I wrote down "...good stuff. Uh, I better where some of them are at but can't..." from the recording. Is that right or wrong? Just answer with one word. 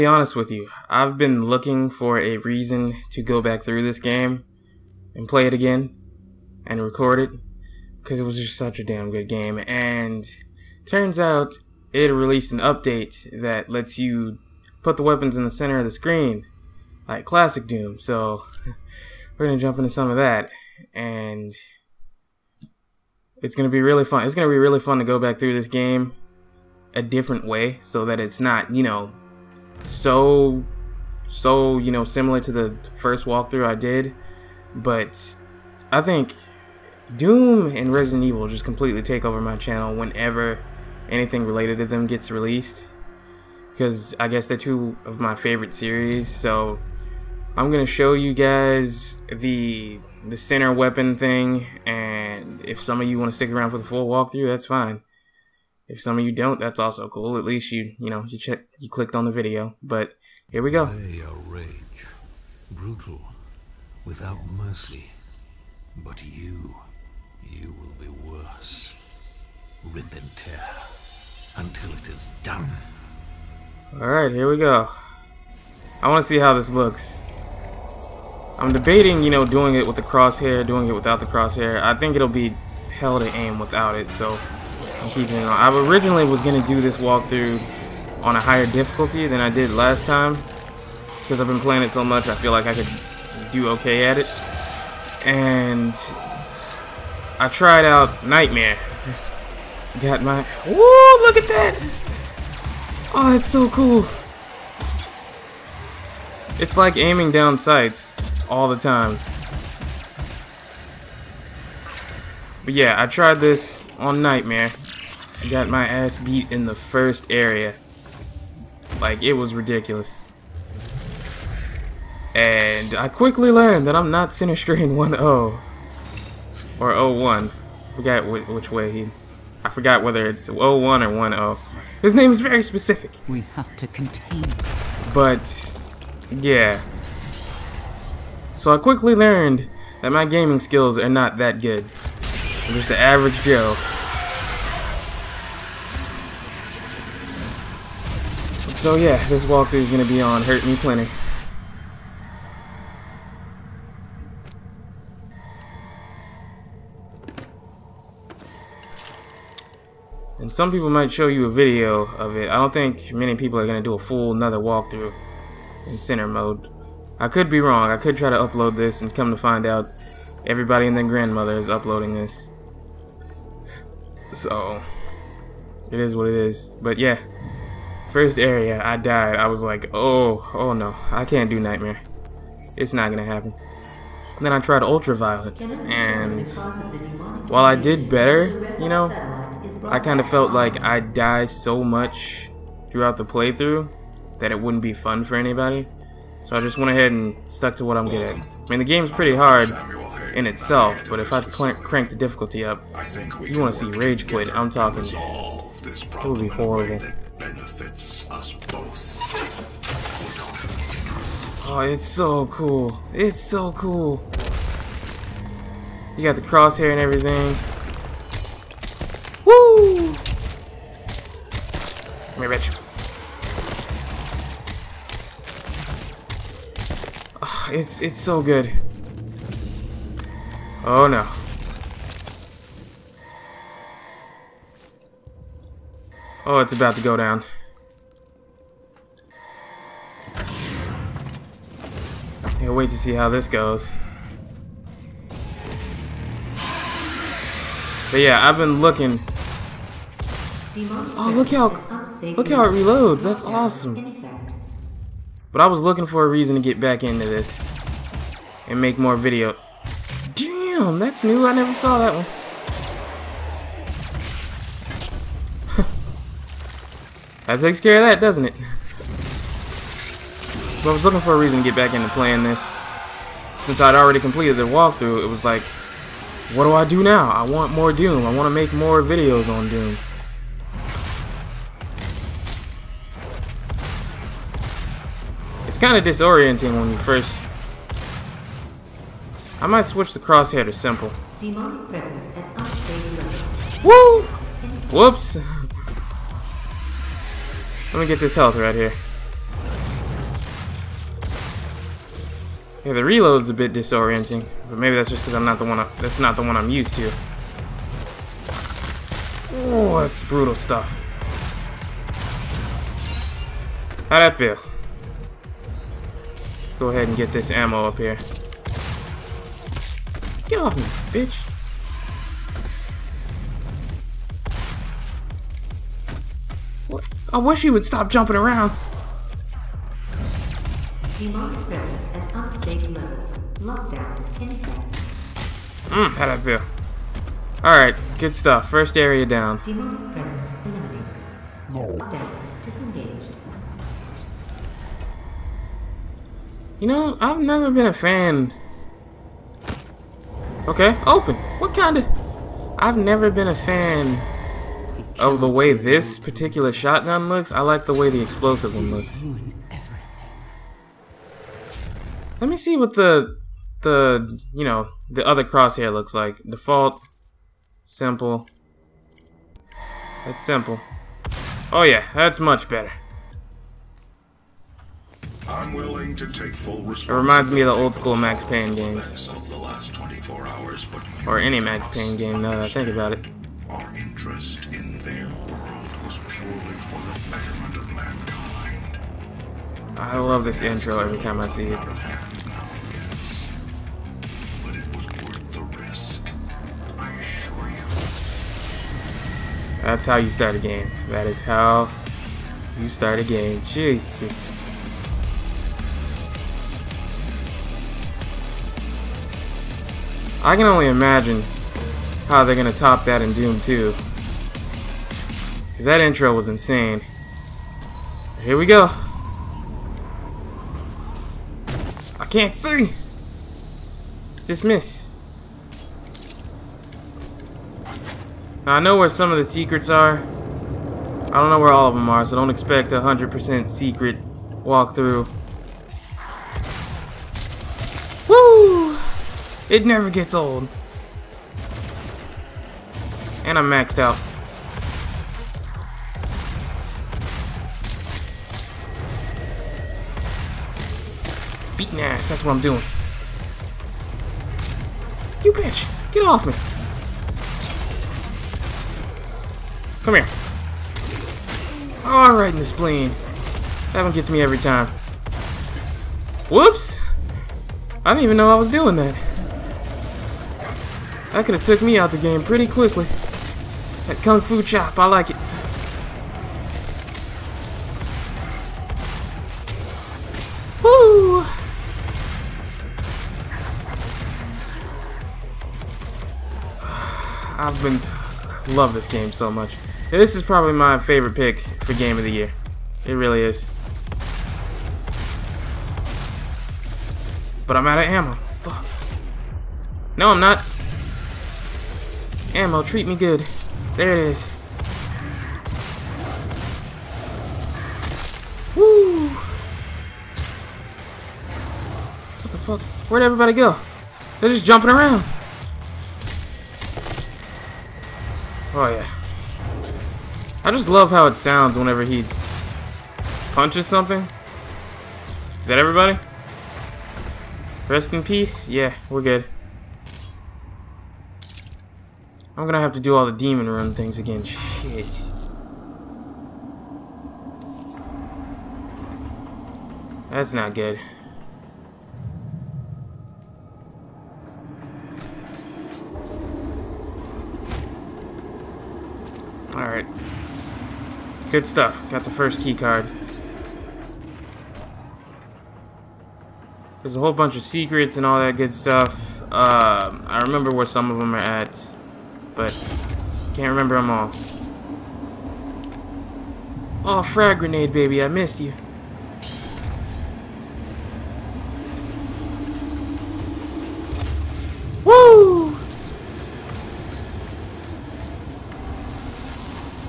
wrong.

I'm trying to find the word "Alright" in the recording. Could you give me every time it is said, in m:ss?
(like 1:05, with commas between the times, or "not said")
5:37, 7:42, 9:09.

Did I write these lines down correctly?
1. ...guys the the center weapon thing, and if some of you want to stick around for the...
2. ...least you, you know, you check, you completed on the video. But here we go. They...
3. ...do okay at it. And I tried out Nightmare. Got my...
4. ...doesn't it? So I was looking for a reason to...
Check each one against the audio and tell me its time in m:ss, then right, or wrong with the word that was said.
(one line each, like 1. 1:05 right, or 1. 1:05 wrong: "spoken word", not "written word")
1. 0:48 right
2. 0:57 wrong: "clicked", not "completed"
3. 1:33 right
4. 4:28 right.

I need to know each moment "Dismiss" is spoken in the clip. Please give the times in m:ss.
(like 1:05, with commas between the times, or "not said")
7:04.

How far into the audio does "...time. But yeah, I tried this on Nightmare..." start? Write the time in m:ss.
1:48.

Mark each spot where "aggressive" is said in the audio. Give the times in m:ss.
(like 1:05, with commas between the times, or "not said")
not said.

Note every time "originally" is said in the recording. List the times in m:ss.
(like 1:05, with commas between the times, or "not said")
1:25.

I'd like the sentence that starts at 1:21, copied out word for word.
I think it'll be hell to aim without it, so I'm keeping it on.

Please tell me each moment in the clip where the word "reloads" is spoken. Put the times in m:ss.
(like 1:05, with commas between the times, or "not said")
4:12, 5:03.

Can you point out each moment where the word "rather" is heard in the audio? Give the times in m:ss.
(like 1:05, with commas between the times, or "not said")
not said.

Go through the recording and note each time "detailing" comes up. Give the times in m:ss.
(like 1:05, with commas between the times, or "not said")
not said.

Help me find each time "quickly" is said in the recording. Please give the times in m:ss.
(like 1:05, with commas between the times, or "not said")
2:03, 2:18, 7:52.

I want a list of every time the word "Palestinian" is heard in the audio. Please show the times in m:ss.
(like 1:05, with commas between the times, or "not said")
not said.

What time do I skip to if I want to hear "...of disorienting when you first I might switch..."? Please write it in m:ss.
4:45.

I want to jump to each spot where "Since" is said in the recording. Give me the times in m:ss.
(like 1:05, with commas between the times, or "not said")
4:33.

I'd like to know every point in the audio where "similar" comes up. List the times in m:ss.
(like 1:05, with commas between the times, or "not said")
0:32.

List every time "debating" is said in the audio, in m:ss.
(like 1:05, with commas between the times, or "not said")
1:18.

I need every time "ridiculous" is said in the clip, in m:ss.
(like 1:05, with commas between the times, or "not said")
1:59.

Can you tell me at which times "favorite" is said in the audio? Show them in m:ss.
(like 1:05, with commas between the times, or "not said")
0:45, 8:10.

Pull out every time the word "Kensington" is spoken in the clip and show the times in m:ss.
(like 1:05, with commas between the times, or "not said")
not said.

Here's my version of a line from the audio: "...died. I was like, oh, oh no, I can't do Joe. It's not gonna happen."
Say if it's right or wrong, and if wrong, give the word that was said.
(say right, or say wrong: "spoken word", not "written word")
wrong: "Nightmare", not "Joe".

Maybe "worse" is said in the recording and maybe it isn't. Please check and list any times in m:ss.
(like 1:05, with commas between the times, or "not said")
1:08.